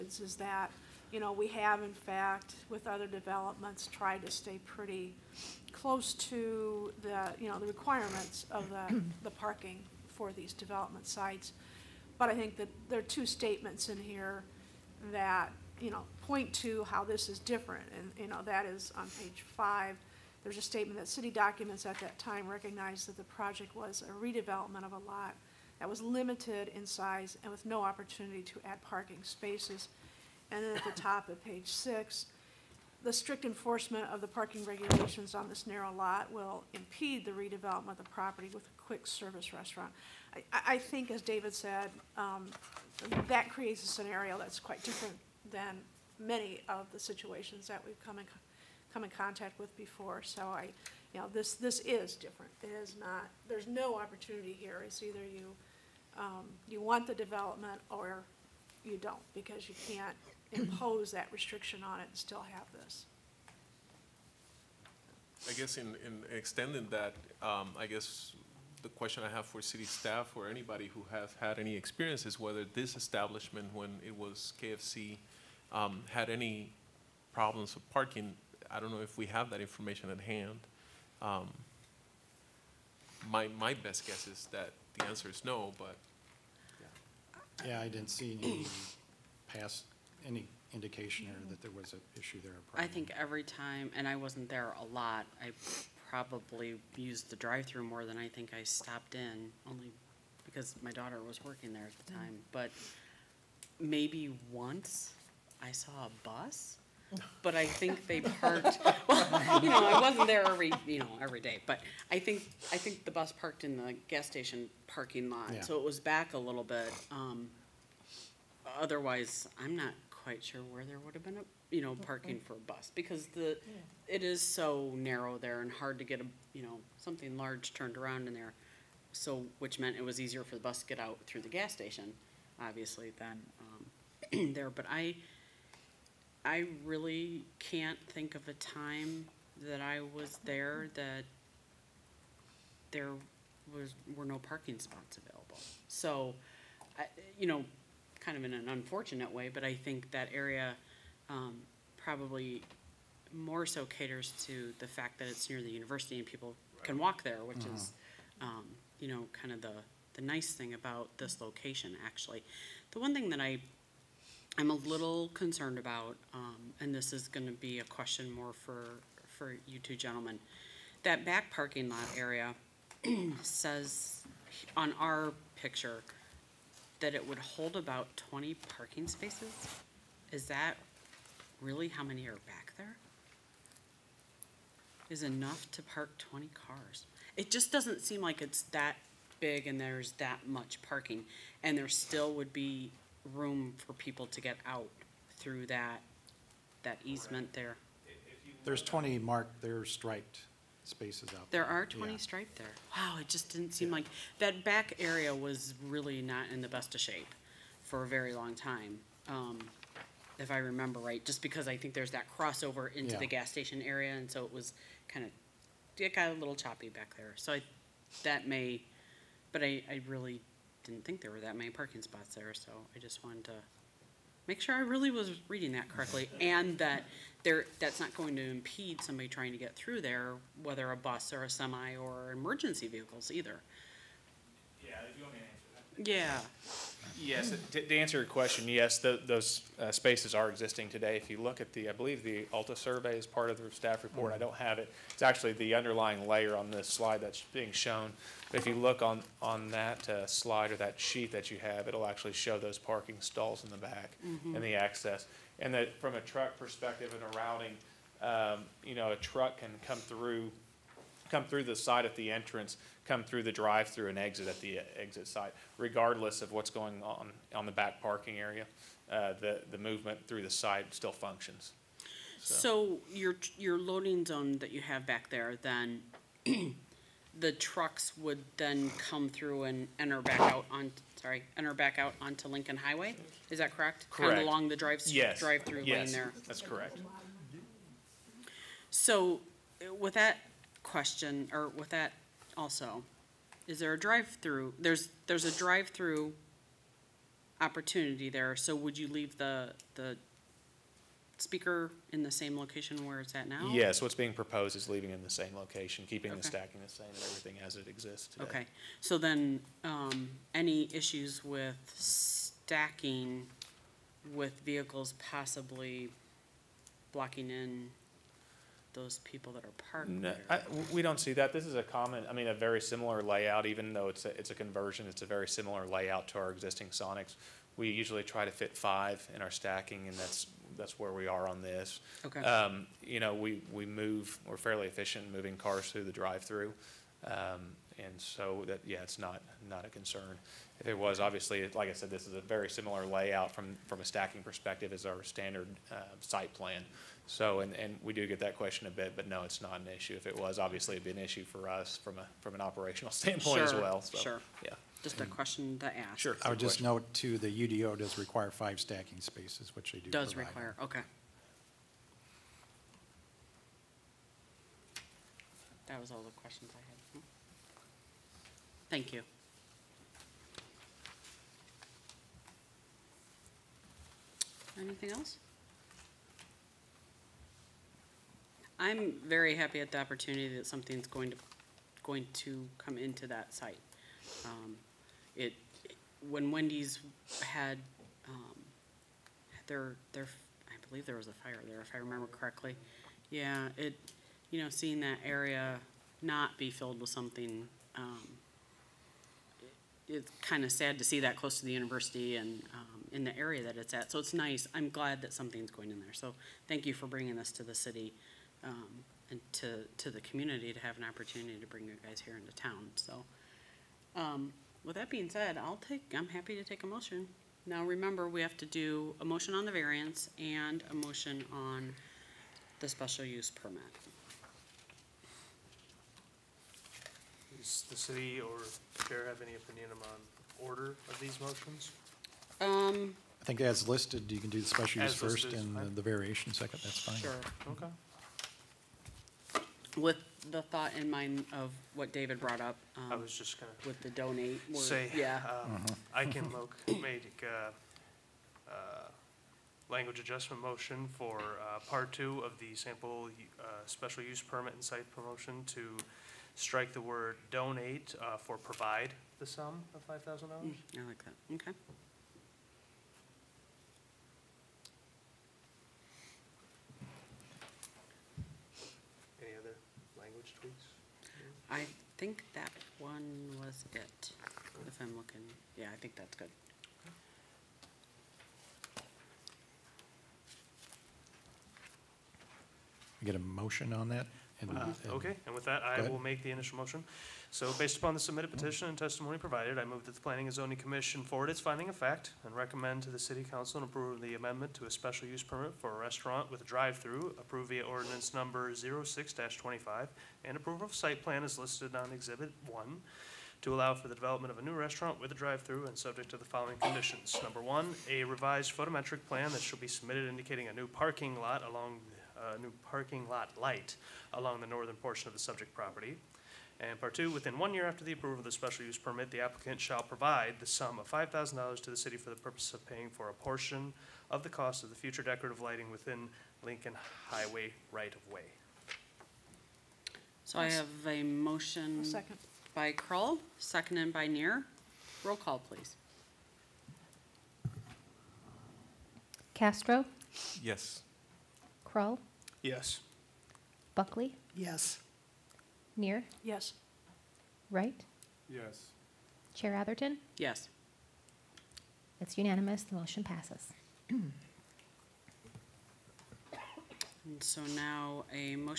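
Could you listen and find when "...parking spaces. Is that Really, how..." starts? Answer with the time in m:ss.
2:58.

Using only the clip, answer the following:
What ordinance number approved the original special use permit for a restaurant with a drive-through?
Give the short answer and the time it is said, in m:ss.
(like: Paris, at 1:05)
06-25, at 8:18.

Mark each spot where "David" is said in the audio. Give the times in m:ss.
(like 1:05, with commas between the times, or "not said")
0:41, 7:22.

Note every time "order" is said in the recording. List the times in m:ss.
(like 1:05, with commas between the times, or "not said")
7:10.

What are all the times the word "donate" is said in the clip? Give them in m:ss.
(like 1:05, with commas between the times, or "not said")
7:24, 7:37.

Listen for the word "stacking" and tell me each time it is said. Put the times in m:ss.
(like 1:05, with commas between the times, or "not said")
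5:06, 5:11, 5:29, 5:44, 5:58.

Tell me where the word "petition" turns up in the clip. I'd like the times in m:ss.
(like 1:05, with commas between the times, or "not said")
8:08.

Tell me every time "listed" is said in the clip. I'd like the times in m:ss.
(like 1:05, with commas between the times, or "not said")
7:13, 8:21.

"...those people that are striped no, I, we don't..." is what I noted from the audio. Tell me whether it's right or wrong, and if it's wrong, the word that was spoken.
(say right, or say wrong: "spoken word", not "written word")
wrong: "parked", not "striped".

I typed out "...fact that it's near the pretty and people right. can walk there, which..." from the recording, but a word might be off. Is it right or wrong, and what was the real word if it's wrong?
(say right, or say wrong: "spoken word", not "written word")
wrong: "university", not "pretty".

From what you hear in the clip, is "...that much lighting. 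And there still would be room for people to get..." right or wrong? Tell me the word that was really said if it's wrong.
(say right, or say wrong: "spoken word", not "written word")
wrong: "parking", not "lighting".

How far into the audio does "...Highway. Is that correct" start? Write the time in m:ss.
4:42.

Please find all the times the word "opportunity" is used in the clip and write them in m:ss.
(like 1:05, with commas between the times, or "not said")
0:27, 0:53, 4:57, 6:19, 6:51.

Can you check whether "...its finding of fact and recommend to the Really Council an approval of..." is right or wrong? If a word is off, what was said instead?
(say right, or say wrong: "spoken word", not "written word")
wrong: "City", not "Really".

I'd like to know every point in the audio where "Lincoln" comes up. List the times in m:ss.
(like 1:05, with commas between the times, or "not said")
4:42, 8:46.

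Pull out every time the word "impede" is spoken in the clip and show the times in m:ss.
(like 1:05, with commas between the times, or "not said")
0:36, 3:48.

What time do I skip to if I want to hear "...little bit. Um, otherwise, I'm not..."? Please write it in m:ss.
1:56.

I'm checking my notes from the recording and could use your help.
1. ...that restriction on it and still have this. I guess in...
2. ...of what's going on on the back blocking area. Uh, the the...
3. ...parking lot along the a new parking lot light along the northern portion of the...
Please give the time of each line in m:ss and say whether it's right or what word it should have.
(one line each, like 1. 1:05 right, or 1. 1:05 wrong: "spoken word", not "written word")
1. 1:01 right
2. 4:26 wrong: "parking", not "blocking"
3. 8:30 right.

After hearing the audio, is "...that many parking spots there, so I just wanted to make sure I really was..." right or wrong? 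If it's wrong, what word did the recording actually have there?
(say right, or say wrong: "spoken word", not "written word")
right.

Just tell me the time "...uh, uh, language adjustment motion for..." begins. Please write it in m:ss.
7:27.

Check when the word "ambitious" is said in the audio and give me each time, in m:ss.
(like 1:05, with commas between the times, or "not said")
not said.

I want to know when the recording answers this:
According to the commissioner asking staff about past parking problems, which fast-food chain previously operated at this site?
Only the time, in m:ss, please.
1:14.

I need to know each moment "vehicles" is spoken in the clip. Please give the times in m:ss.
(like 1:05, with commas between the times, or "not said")
3:52, 5:14.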